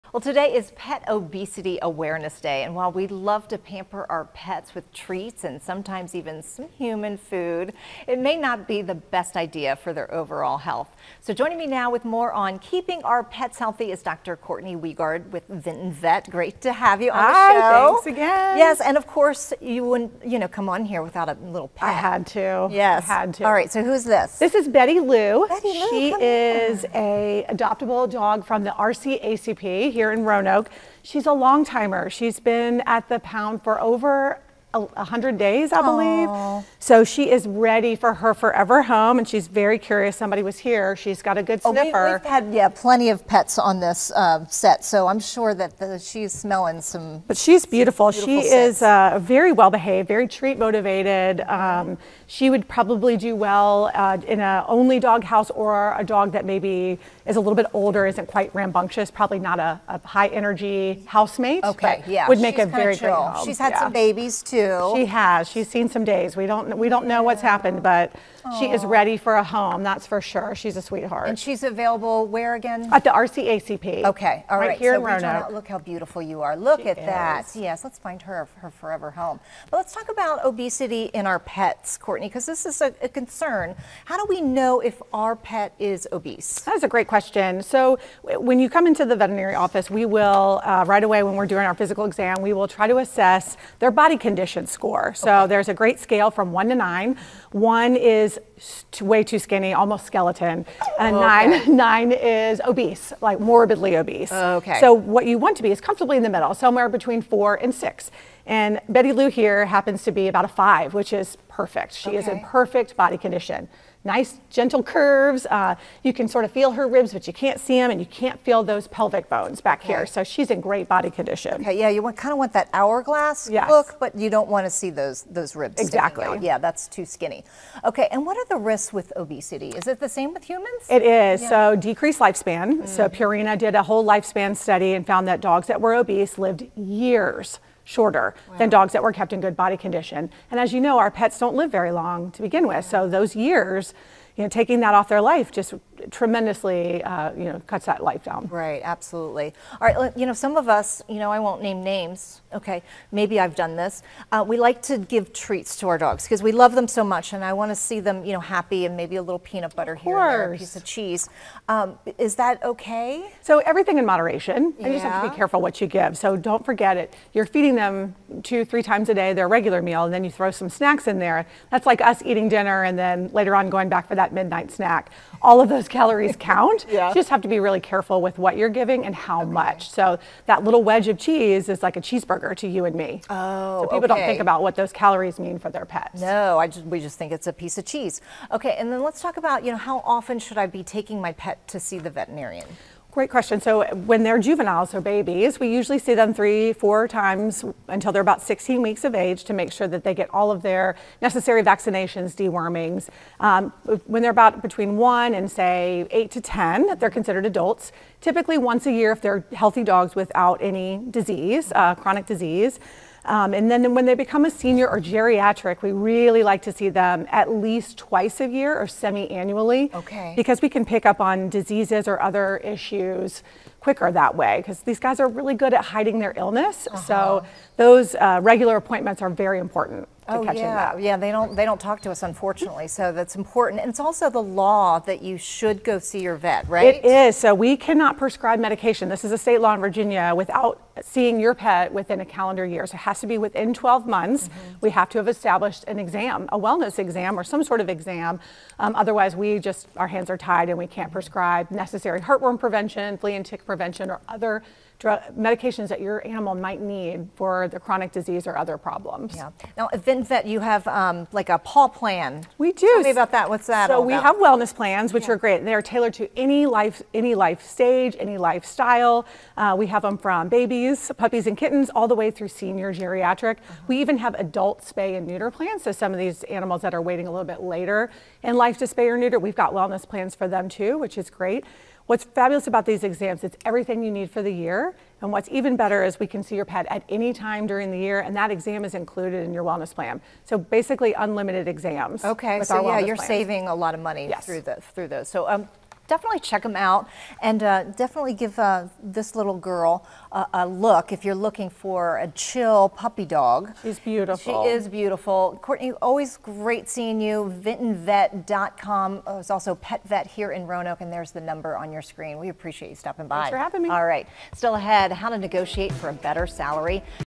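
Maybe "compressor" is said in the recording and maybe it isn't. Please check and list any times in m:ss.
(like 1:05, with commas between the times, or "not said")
not said.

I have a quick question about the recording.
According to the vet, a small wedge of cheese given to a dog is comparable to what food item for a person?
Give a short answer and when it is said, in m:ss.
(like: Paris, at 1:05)
cheeseburger, at 3:02.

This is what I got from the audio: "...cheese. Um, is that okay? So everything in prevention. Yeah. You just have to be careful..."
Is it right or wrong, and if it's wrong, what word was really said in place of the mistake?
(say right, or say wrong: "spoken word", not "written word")
wrong: "moderation", not "prevention".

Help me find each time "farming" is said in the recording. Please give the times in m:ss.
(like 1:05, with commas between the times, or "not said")
not said.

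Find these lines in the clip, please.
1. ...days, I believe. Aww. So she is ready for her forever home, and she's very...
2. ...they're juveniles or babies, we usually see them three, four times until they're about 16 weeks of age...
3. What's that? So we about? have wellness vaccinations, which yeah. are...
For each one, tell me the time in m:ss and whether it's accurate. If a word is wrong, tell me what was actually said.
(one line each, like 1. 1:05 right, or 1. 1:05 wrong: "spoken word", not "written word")
1. 0:35 right
2. 3:14 right
3. 4:23 wrong: "plans", not "vaccinations".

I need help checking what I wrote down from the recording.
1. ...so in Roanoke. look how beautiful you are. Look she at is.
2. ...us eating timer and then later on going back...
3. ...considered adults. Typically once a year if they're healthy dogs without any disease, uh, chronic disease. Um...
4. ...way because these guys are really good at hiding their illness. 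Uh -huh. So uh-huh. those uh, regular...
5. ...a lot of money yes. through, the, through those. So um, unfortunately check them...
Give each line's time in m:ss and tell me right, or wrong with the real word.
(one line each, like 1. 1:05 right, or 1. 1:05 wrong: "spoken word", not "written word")
1. 1:14 right
2. 2:52 wrong: "dinner", not "timer"
3. 3:27 right
4. 3:44 right
5. 4:53 wrong: "definitely", not "unfortunately".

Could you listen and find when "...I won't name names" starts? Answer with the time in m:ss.
2:31.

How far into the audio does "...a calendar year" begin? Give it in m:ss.
4:02.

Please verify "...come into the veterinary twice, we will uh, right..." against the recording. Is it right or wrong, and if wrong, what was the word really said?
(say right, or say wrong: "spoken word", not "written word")
wrong: "office", not "twice".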